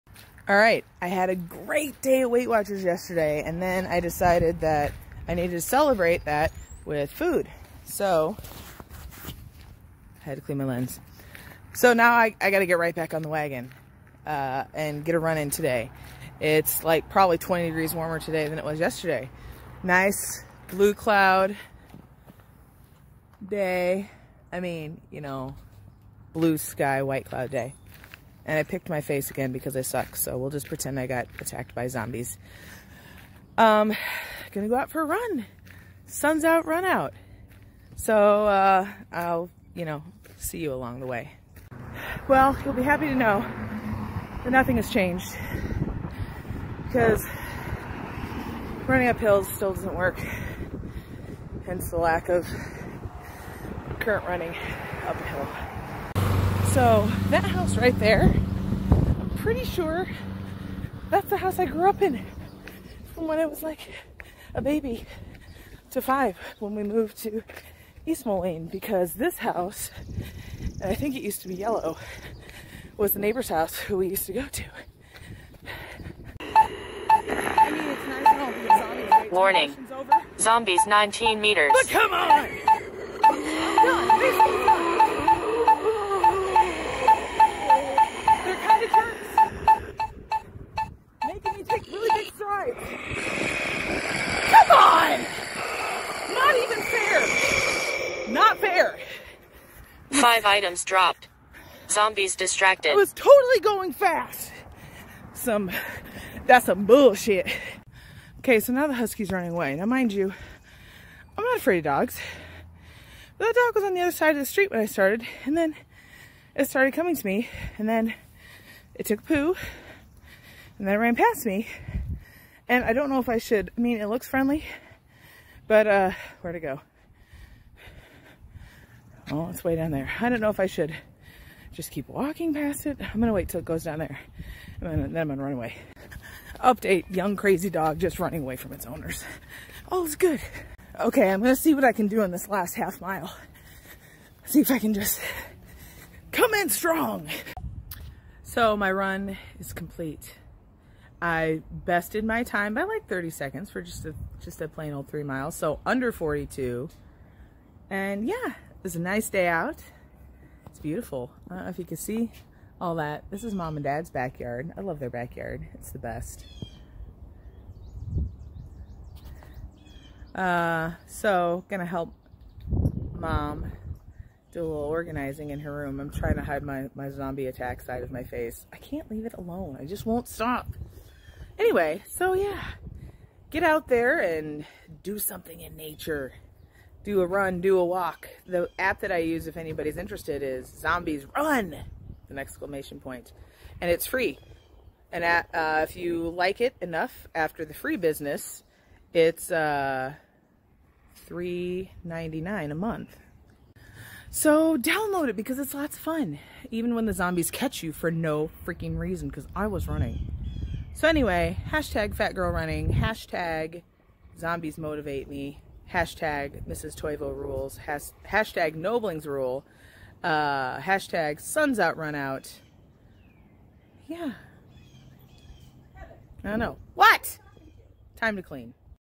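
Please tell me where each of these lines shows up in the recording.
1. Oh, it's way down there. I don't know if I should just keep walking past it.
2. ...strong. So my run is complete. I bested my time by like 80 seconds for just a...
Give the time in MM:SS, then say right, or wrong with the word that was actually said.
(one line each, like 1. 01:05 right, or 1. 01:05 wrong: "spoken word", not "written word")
1. 02:09 right
2. 02:26 wrong: "30", not "80".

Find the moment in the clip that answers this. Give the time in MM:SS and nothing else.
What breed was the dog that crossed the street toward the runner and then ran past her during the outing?
01:48.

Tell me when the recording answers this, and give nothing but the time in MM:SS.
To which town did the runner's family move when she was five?
01:08.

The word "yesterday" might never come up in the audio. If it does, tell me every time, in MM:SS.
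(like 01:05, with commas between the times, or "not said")
00:02, 00:18.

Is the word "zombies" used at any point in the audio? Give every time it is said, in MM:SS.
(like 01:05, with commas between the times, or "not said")
00:31, 01:20, 01:41, 02:57, 03:10, 03:27, 03:34.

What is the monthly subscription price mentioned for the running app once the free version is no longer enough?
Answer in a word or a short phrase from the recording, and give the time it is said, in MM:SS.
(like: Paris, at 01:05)
$3.99, at 03:21.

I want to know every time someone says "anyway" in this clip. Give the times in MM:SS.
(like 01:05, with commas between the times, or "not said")
03:01, 03:31.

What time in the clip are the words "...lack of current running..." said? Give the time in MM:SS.
00:51.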